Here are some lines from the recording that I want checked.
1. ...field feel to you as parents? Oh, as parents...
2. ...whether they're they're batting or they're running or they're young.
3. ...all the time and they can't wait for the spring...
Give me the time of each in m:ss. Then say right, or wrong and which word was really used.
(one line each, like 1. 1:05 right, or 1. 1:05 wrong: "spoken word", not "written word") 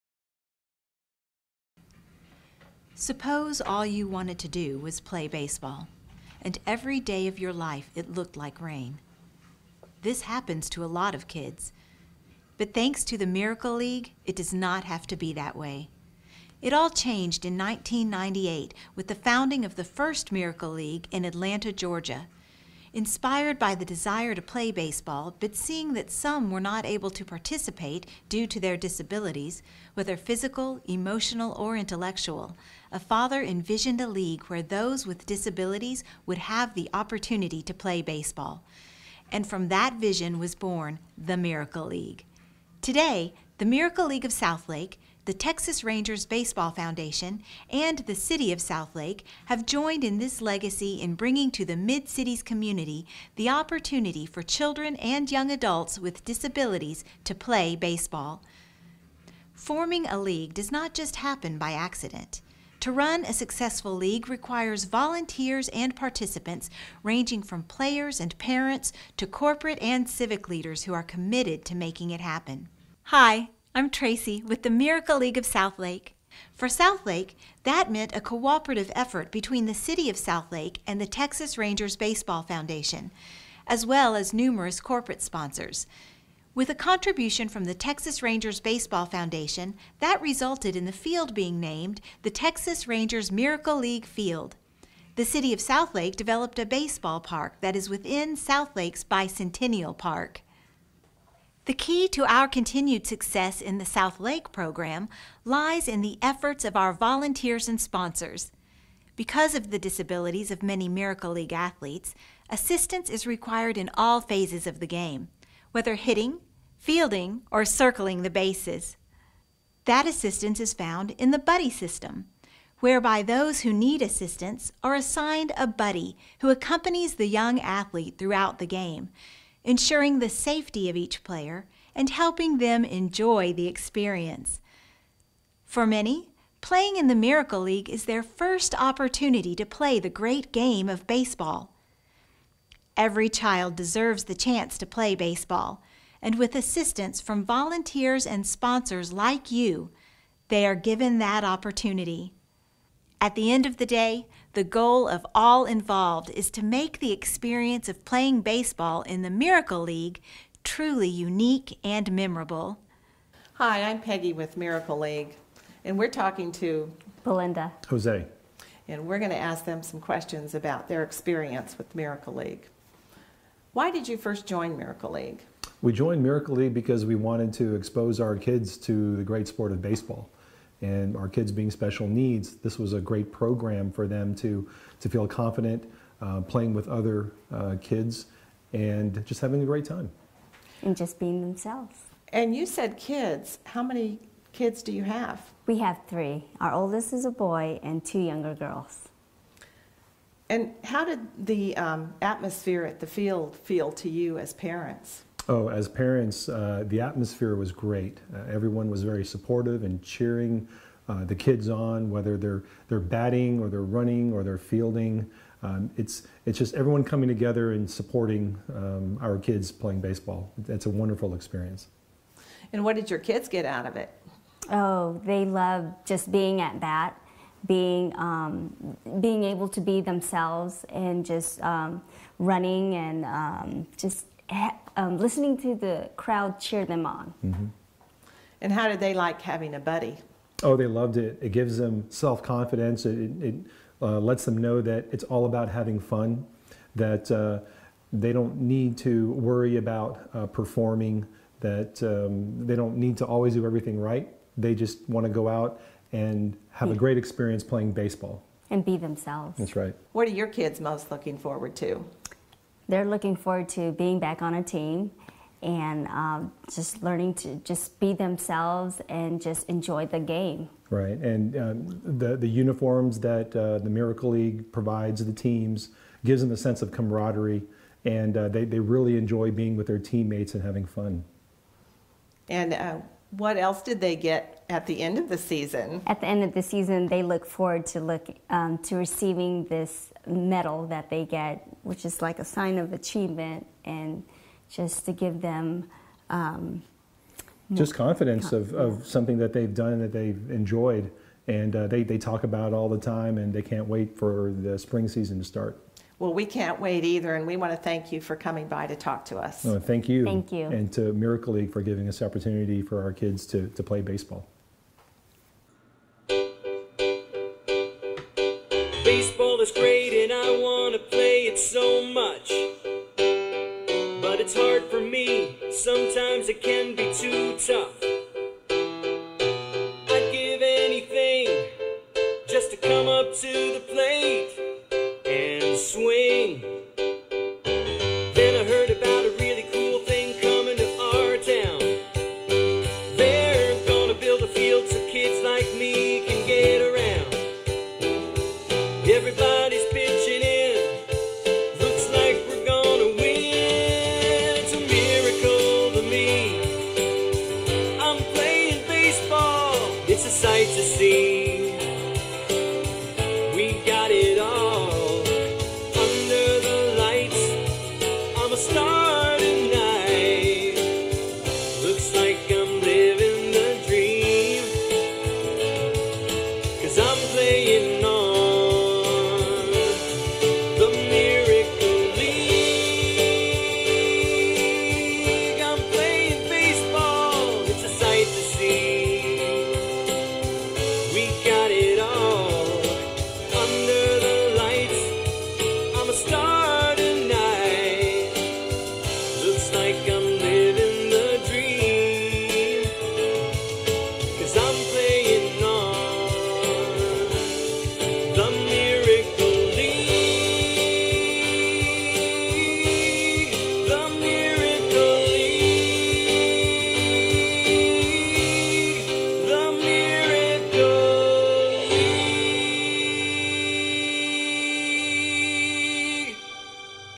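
1. 3:23 right
2. 3:32 wrong: "fielding", not "young"
3. 5:02 right.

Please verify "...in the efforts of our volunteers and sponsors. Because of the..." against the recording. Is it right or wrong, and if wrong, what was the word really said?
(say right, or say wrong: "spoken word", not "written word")
right.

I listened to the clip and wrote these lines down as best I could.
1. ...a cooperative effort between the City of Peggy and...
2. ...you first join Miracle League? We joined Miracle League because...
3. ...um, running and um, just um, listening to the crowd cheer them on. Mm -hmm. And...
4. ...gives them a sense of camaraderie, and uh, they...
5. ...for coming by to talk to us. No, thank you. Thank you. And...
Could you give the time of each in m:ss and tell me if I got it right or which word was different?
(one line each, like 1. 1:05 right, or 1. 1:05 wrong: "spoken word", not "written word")
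1. 1:18 wrong: "Southlake", not "Peggy"
2. 2:54 right
3. 3:51 right
4. 4:36 right
5. 5:08 right.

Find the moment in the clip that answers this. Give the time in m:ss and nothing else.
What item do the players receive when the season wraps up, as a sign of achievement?
4:50.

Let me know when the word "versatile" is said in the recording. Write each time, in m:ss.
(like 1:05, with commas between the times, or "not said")
not said.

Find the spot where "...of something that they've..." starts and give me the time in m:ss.
4:58.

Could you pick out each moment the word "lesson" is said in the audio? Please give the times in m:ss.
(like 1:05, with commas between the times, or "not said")
not said.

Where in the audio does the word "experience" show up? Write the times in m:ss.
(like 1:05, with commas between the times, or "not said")
2:13, 2:37, 2:51, 3:41, 4:17.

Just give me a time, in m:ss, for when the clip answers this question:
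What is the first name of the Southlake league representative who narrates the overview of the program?
1:13.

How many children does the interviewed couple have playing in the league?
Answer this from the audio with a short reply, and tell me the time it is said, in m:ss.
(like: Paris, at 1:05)
3, at 3:16.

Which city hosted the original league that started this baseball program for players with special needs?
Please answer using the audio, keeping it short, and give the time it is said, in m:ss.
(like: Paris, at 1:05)
Atlanta, Georgia, at 0:21.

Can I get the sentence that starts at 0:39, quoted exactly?
And from that vision was born the Miracle League.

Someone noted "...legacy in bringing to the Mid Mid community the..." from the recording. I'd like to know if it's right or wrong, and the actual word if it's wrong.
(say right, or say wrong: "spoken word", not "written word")
wrong: "Cities", not "Mid".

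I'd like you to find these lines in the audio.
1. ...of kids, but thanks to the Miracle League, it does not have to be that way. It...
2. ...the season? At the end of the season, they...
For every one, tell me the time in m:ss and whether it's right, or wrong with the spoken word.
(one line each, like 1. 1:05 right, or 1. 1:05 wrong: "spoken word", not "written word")
1. 0:11 right
2. 4:45 right.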